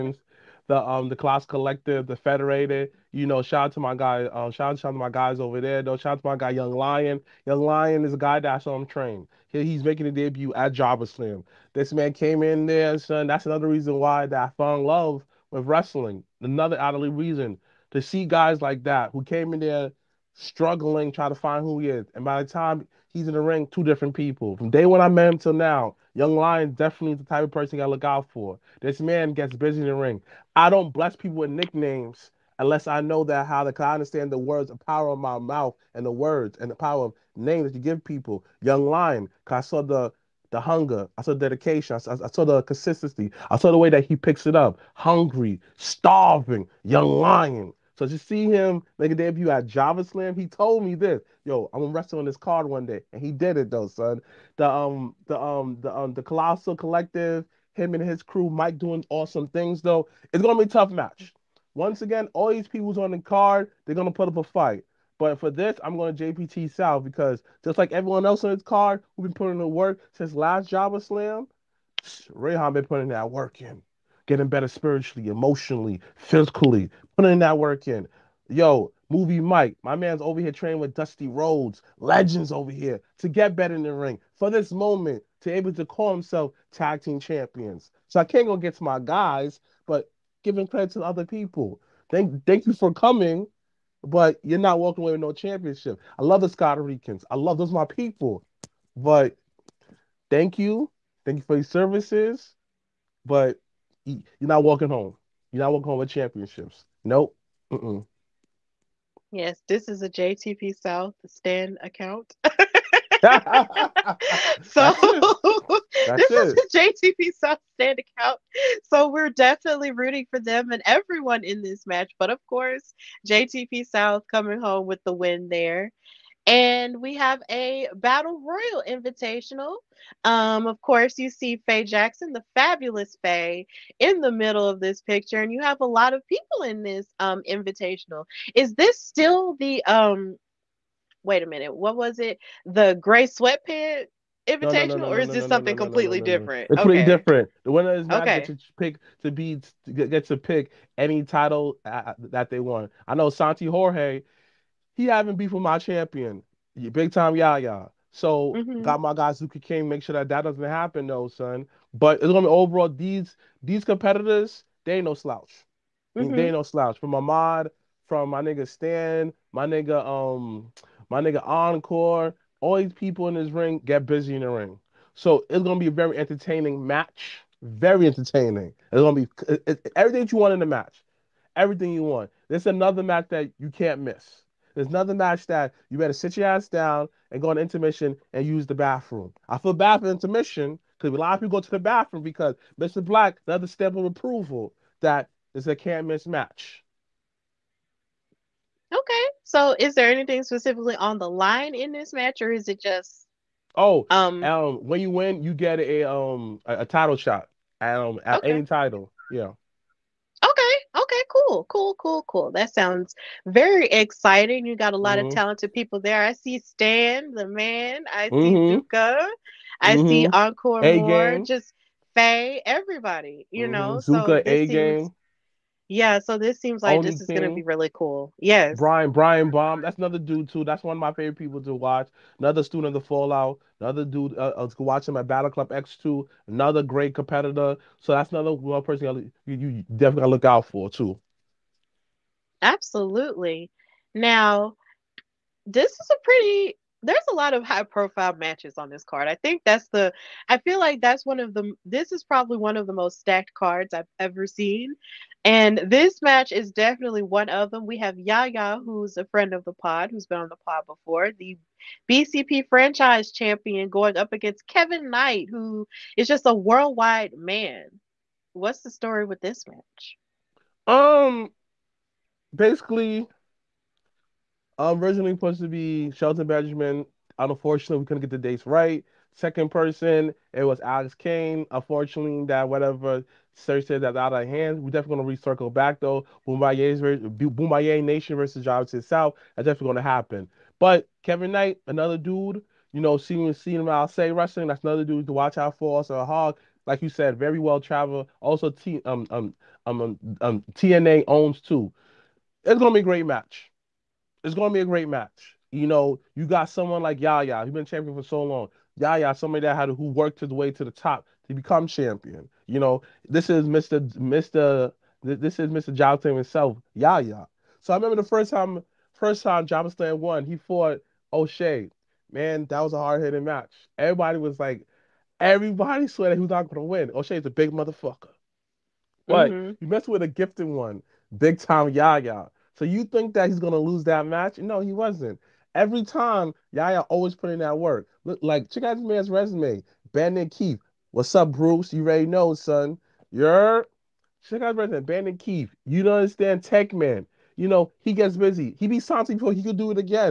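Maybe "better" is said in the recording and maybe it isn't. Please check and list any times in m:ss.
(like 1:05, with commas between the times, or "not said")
1:14, 1:23, 3:05.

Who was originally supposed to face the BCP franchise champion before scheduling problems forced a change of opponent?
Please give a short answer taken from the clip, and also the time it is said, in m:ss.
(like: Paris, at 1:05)
Shelton Benjamin, at 4:36.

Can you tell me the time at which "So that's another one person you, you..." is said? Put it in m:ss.
3:57.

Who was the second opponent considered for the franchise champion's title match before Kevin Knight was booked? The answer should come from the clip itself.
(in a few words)
Alex Kane.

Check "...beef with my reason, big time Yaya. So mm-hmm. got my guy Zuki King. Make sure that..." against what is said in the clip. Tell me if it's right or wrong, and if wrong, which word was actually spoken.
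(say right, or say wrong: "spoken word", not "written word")
wrong: "champion", not "reason".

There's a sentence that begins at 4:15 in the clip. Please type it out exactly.
And this match is definitely one of them.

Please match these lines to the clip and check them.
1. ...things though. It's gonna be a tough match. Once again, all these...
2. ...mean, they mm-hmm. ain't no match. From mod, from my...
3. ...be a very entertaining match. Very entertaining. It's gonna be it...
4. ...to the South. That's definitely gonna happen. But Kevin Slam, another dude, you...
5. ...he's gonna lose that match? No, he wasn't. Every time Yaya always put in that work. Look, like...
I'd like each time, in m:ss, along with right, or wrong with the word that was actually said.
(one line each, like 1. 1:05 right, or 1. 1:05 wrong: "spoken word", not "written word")
1. 0:59 right
2. 2:46 wrong: "slouch", not "match"
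3. 2:55 right
4. 4:48 wrong: "Knight", not "Slam"
5. 5:33 right.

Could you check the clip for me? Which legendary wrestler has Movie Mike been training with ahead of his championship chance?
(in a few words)
Dustin Rhodes.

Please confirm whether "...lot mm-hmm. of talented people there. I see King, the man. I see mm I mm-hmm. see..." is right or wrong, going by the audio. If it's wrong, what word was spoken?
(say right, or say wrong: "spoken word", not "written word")
wrong: "Stan", not "King".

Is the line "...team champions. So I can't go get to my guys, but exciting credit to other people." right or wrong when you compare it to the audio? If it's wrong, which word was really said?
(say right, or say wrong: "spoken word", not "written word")
wrong: "giving", not "exciting".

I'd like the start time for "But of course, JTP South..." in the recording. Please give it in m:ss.
2:02.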